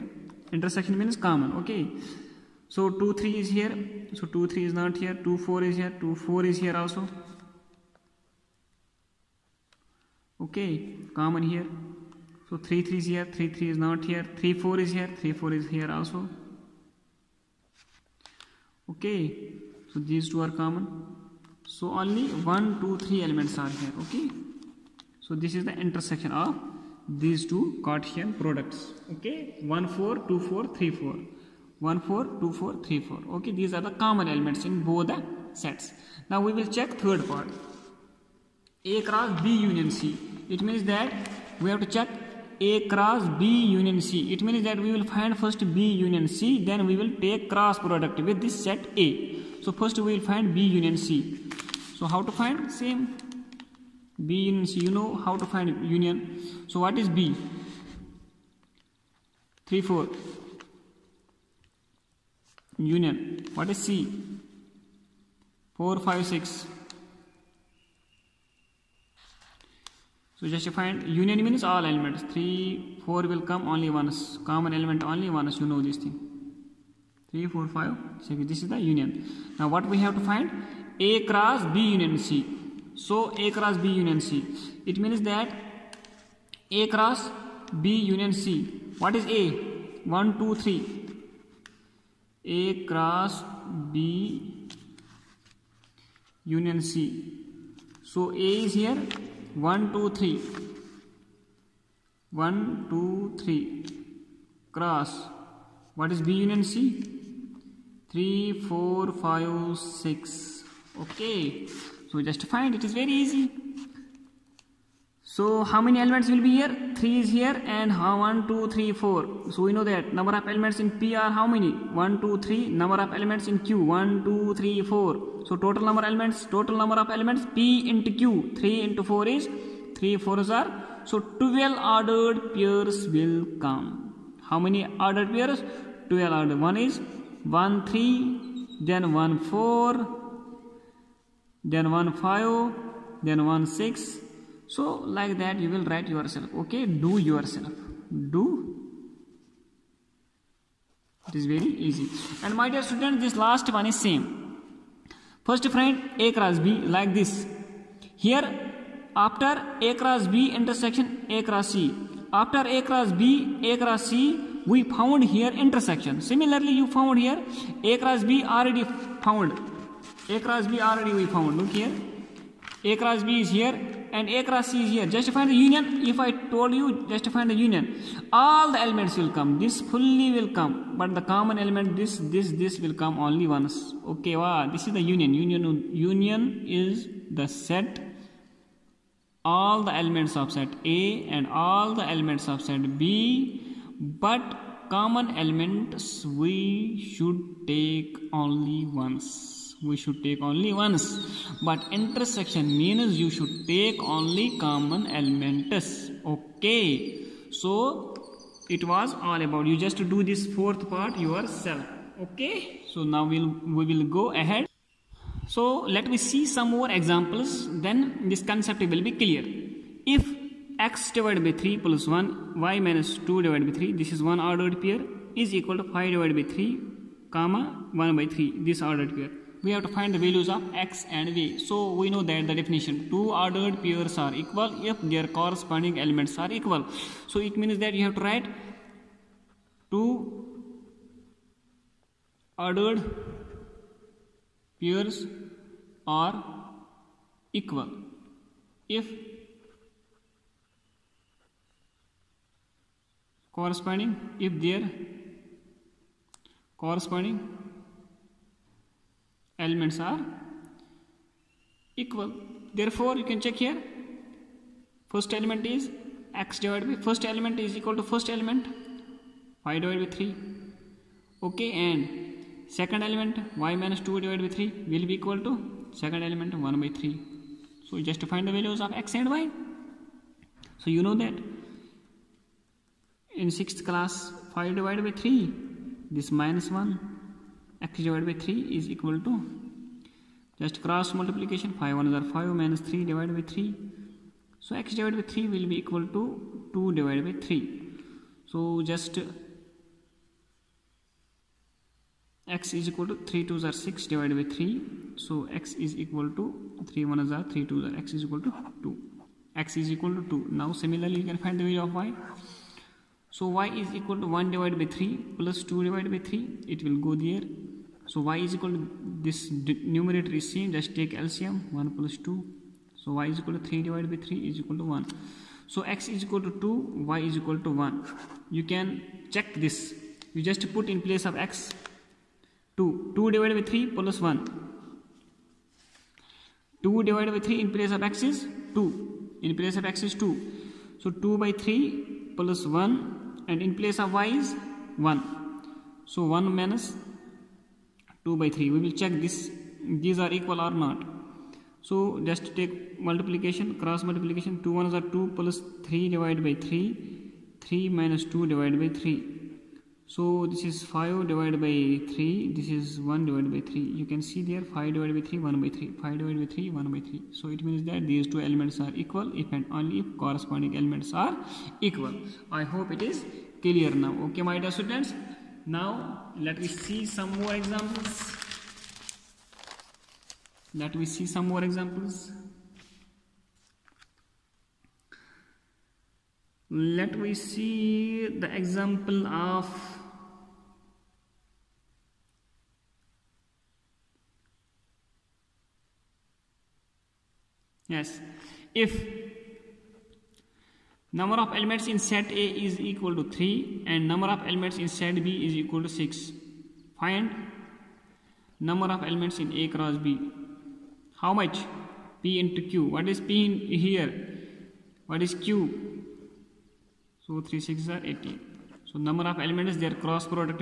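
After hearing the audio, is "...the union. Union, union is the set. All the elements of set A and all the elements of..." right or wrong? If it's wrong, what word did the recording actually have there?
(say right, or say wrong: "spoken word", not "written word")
right.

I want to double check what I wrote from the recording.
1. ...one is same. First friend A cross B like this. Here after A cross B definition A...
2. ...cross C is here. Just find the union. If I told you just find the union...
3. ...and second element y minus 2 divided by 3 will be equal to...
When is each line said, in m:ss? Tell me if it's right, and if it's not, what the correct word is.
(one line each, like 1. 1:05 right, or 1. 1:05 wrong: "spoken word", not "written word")
1. 2:33 wrong: "intersection", not "definition"
2. 2:54 right
3. 4:31 right.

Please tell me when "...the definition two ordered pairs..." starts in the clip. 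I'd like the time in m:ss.
3:52.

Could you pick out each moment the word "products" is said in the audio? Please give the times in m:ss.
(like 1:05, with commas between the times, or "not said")
0:28, 0:47.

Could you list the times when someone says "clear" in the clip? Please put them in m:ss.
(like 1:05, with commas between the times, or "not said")
3:39, 6:13.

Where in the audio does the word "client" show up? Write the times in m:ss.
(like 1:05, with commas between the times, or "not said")
not said.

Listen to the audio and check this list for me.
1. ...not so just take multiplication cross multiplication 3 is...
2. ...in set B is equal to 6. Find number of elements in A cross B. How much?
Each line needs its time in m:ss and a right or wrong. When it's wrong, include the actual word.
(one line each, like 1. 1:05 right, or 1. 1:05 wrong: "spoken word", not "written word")
1. 5:50 wrong: "2", not "3"
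2. 6:44 right.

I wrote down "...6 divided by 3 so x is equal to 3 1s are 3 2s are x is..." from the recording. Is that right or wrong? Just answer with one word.
right.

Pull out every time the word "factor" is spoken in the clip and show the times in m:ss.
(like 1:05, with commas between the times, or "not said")
not said.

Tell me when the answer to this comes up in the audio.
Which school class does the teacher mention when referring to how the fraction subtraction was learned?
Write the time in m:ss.
4:43.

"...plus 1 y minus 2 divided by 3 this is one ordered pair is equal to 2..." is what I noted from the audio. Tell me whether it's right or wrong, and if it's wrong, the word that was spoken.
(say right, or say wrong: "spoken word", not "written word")
wrong: "5", not "2".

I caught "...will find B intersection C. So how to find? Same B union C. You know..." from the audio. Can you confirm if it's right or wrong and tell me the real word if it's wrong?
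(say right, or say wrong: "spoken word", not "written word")
wrong: "union", not "intersection".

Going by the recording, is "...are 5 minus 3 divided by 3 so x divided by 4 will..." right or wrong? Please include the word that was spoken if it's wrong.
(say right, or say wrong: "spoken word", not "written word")
wrong: "3", not "4".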